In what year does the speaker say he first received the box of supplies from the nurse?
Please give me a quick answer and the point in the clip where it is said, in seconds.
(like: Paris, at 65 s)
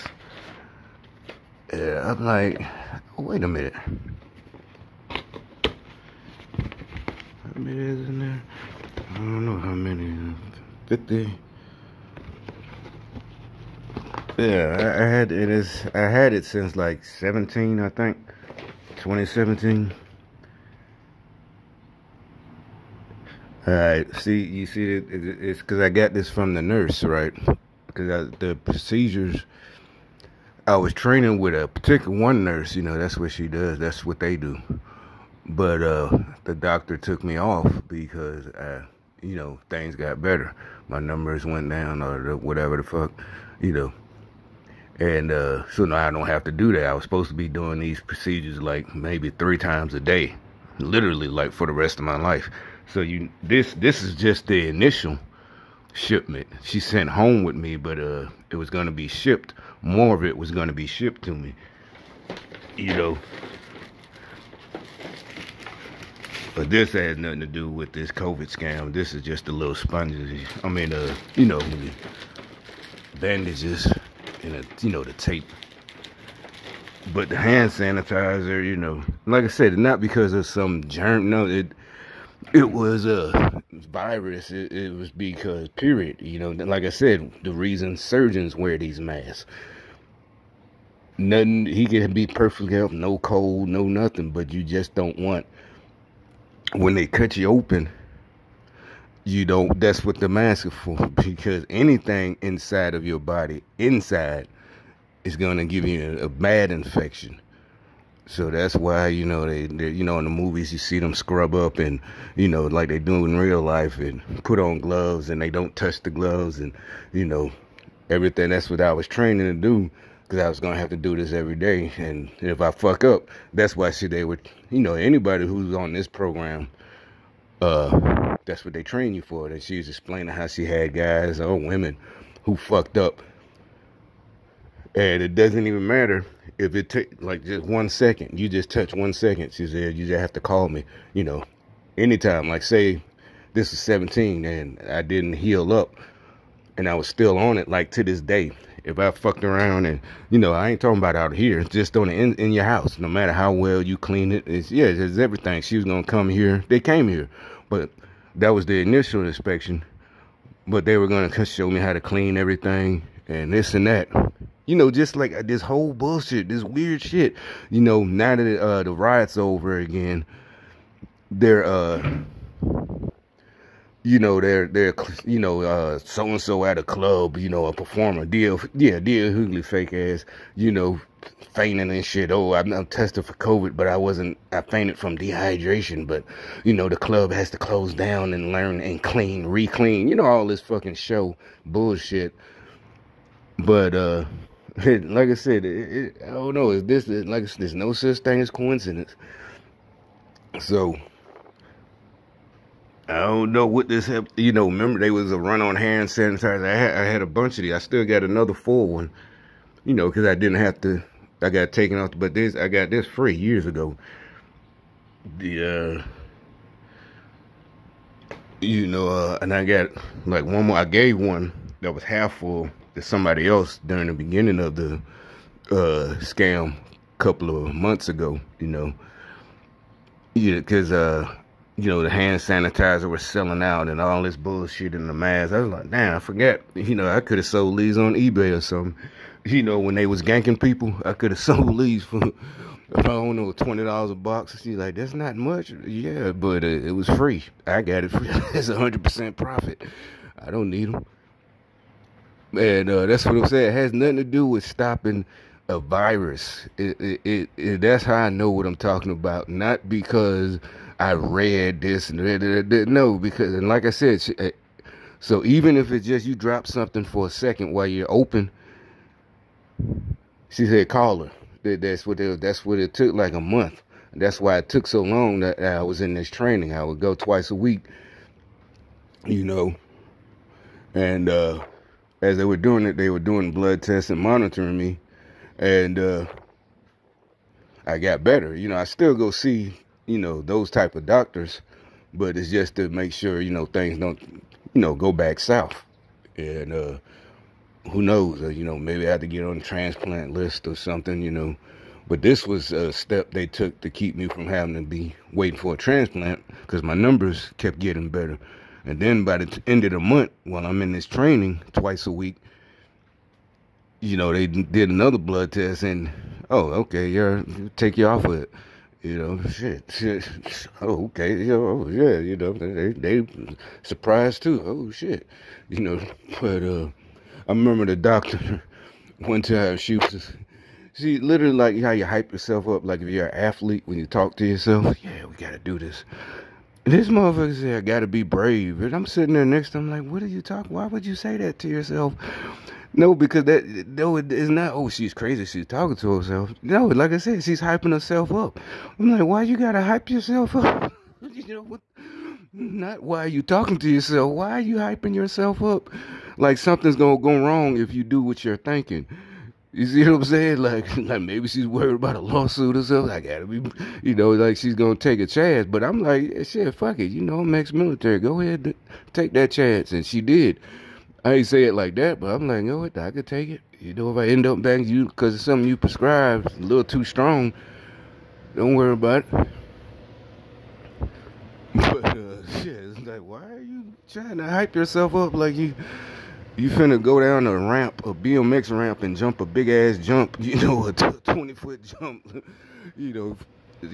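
2017, at 18 s.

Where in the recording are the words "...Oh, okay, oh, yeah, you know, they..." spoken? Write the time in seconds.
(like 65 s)
320 s.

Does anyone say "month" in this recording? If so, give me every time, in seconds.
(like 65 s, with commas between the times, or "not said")
227 s, 273 s, 309 s.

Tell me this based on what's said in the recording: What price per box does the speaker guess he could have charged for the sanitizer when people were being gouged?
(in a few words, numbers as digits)
$20.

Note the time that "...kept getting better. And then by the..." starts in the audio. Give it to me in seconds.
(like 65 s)
307 s.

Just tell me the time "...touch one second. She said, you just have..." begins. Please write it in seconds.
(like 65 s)
138 s.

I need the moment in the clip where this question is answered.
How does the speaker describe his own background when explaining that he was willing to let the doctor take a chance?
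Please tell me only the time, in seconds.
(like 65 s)
367 s.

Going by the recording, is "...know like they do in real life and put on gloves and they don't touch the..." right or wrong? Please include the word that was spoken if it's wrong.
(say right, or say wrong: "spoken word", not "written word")
right.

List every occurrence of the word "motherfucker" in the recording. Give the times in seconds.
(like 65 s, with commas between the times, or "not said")
337 s.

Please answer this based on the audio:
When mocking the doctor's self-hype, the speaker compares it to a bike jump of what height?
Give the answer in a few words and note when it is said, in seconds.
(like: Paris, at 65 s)
20 foot, at 390 s.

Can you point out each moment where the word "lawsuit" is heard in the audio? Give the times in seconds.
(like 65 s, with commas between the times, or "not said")
362 s.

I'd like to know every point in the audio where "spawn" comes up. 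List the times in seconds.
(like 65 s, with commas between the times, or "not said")
not said.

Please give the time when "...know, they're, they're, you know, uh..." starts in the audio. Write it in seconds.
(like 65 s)
174 s.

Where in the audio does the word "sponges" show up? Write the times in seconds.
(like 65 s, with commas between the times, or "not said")
69 s.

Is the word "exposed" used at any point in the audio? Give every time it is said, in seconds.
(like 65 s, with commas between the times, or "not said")
not said.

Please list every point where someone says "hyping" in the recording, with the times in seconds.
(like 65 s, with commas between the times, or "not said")
347 s, 354 s.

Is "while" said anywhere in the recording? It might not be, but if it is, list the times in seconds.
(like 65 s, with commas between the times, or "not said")
267 s, 310 s.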